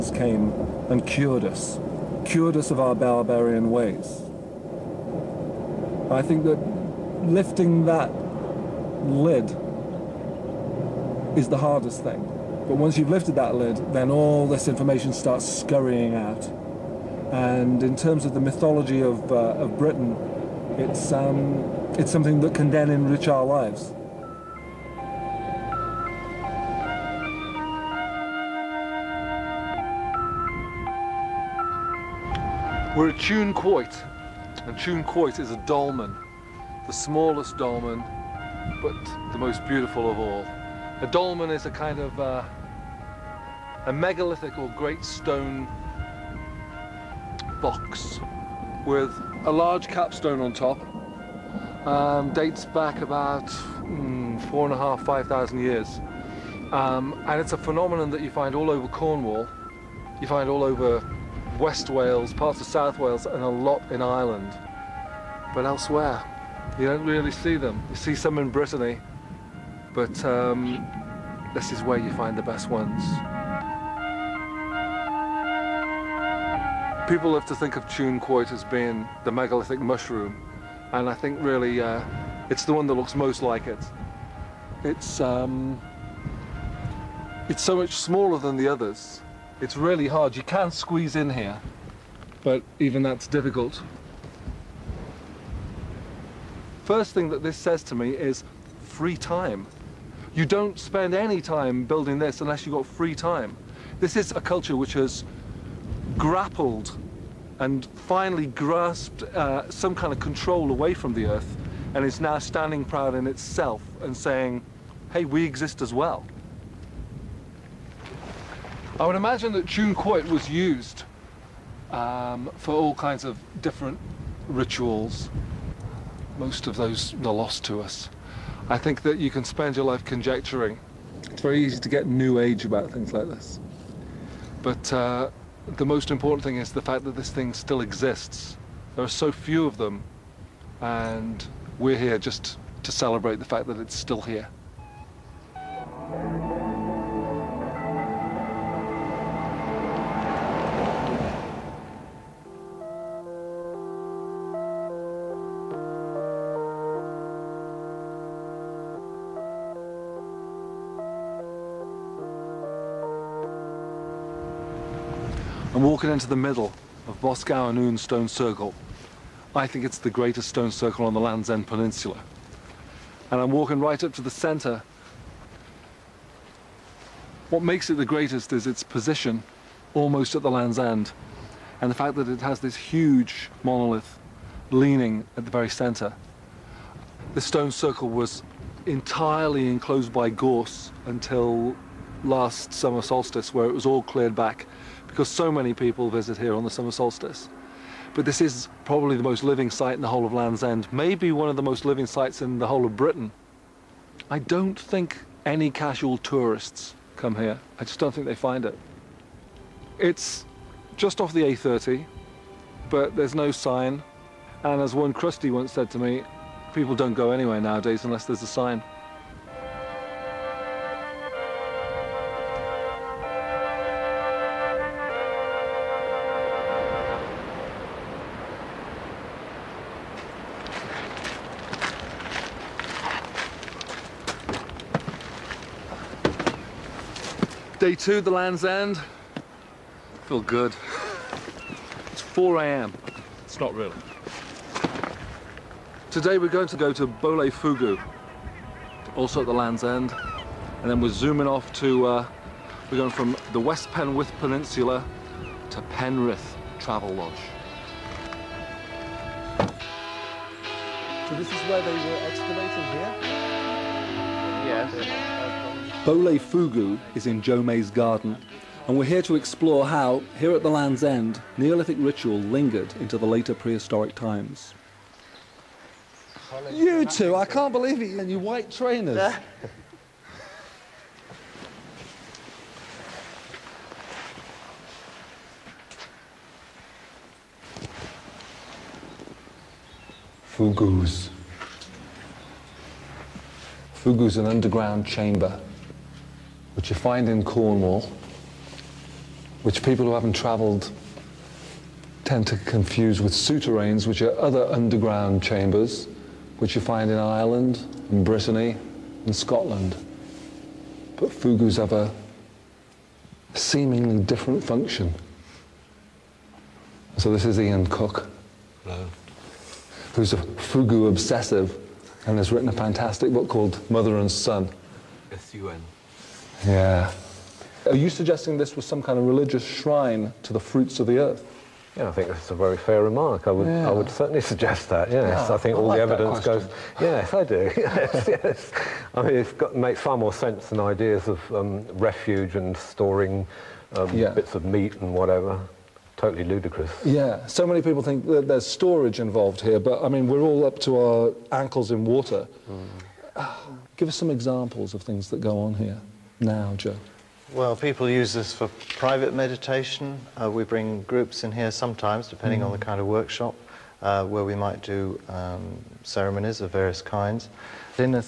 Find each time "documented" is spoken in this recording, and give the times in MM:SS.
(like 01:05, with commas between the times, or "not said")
not said.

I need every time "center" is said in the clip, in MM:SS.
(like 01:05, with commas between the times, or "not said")
02:54, 03:05.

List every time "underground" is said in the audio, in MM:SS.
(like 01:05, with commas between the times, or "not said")
04:54, 05:04.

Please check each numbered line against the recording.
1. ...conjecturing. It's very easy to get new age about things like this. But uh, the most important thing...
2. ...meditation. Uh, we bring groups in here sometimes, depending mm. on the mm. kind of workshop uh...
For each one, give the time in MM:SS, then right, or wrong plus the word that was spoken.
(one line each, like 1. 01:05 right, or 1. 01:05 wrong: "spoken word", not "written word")
1. 02:10 right
2. 05:59 right.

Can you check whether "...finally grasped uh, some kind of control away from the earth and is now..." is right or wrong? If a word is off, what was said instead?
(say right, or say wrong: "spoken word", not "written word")
right.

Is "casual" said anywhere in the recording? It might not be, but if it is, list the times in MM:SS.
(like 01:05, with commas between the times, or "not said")
03:25.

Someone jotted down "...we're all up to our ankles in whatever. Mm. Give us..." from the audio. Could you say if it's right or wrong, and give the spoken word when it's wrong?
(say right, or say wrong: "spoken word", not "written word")
wrong: "water", not "whatever".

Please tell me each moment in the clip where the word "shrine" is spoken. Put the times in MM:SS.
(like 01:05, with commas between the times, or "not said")
05:29.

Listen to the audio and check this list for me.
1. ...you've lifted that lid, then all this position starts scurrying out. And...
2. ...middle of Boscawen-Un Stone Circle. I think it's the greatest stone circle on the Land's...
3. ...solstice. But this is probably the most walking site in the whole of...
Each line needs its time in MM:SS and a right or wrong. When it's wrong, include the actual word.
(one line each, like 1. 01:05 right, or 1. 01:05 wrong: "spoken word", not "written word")
1. 00:12 wrong: "information", not "position"
2. 02:46 right
3. 03:16 wrong: "living", not "walking".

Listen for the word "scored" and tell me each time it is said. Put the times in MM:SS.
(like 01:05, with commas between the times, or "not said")
not said.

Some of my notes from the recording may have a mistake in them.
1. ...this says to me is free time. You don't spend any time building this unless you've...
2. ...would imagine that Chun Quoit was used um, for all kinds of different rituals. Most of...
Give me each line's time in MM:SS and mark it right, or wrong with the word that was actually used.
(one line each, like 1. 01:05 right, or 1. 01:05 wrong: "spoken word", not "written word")
1. 01:37 right
2. 01:59 right.